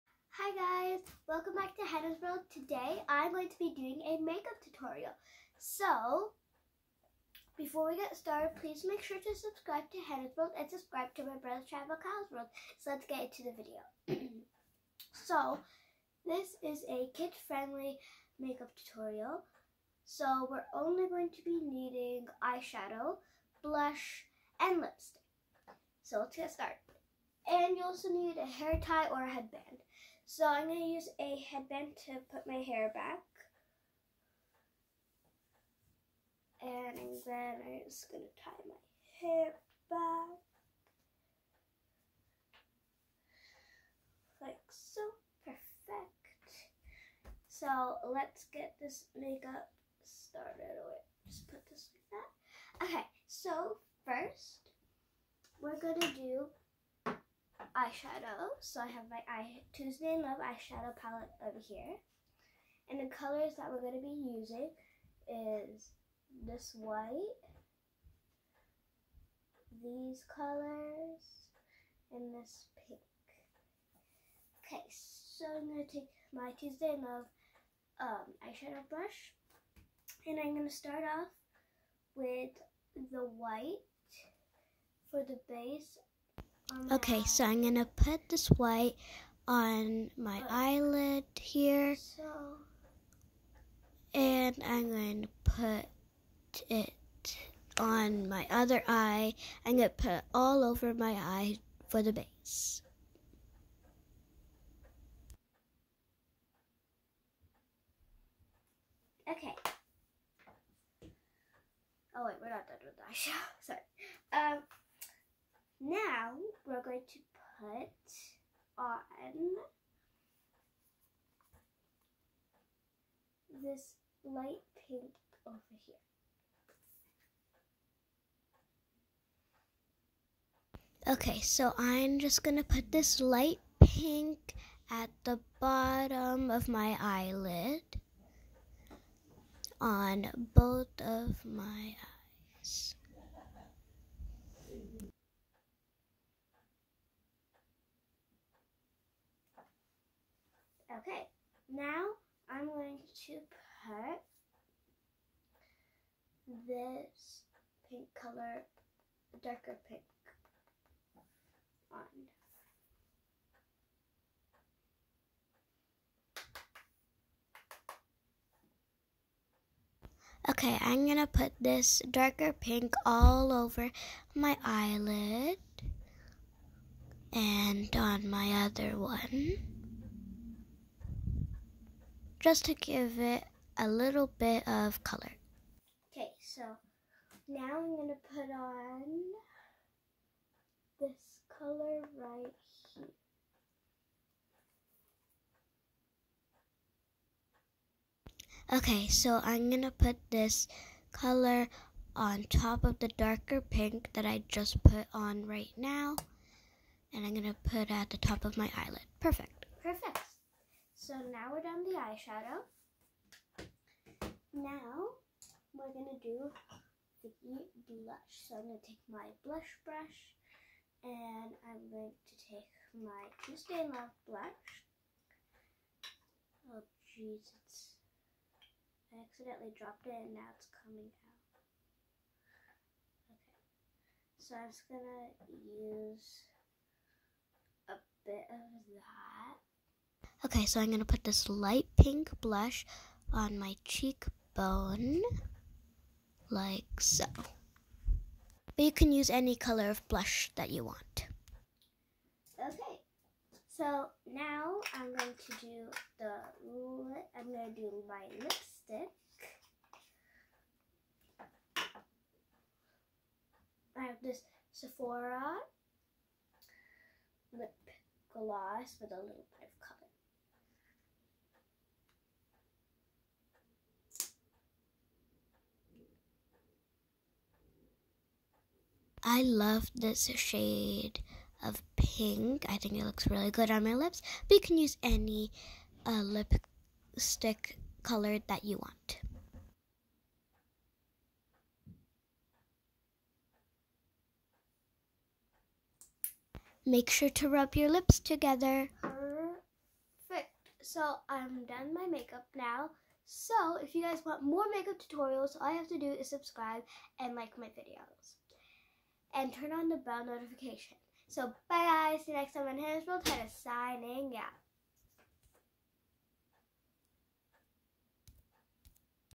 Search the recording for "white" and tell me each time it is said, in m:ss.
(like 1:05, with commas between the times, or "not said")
1:06, 1:23, 1:28.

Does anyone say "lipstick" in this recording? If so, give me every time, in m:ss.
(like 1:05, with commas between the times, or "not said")
0:24, 4:18, 4:46.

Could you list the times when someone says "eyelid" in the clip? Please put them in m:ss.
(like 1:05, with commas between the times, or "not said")
1:30, 2:17, 2:54, 3:28.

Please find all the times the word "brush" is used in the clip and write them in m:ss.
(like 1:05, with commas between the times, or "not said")
1:18, 3:39.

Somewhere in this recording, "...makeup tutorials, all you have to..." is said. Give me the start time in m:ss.
5:04.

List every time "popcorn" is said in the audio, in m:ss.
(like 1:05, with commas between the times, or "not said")
not said.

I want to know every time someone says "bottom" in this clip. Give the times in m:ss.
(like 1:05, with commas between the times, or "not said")
2:15.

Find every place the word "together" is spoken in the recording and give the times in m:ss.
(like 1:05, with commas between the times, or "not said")
4:58.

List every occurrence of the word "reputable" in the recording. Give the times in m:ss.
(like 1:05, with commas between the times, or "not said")
not said.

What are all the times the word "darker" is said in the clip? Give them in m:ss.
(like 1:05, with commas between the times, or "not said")
2:39, 2:52, 3:23.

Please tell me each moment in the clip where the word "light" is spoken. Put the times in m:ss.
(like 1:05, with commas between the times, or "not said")
2:04, 2:13, 4:01.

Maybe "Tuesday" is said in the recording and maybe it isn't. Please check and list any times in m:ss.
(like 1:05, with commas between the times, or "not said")
0:59, 1:16, 3:43.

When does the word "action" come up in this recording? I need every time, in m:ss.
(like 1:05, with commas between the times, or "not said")
not said.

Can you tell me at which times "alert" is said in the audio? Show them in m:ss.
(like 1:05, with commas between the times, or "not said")
not said.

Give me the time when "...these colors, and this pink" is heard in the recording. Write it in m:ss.
1:09.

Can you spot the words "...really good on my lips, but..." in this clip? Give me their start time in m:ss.
4:43.